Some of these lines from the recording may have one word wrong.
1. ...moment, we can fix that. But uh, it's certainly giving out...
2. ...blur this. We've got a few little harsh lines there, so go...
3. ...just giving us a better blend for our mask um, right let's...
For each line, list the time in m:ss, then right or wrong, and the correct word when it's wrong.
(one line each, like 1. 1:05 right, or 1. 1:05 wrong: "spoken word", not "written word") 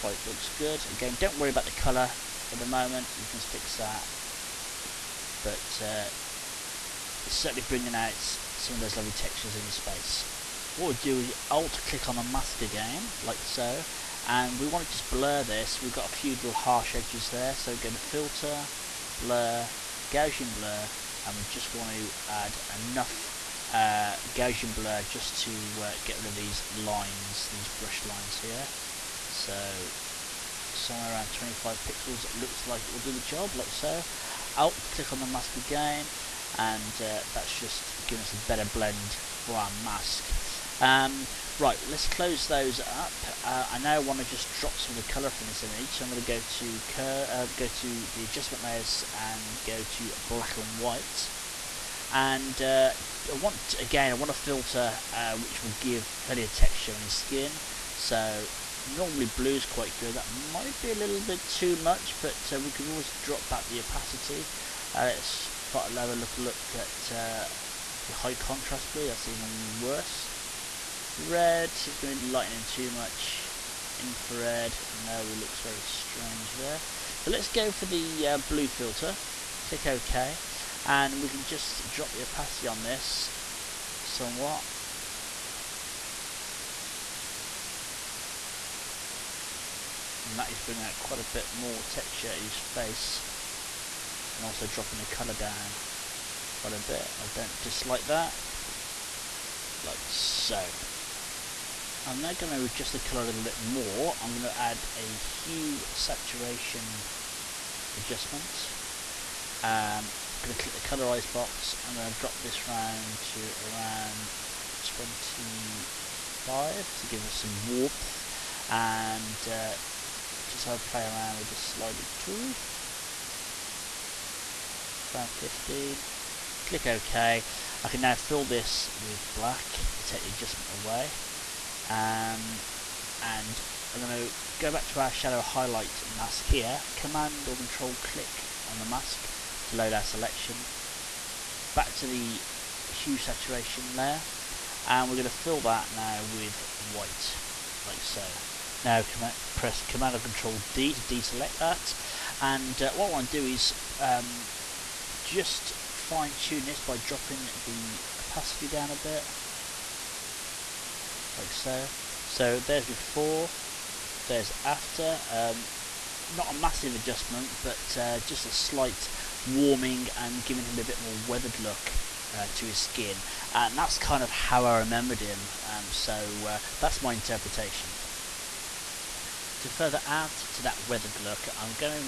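1. 0:02 wrong: "bringing", not "giving"
2. 0:15 wrong: "edges", not "lines"
3. 0:37 right.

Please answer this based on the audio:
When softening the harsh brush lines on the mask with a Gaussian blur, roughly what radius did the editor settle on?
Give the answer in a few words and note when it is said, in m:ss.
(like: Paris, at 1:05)
25 pixels, at 0:31.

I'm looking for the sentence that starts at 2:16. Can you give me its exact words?
Command or Control click on the mask to load our selection.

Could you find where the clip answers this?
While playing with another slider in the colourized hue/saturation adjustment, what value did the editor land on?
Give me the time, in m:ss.
2:05.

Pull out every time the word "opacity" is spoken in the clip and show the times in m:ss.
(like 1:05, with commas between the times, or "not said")
1:03, 1:22, 2:38.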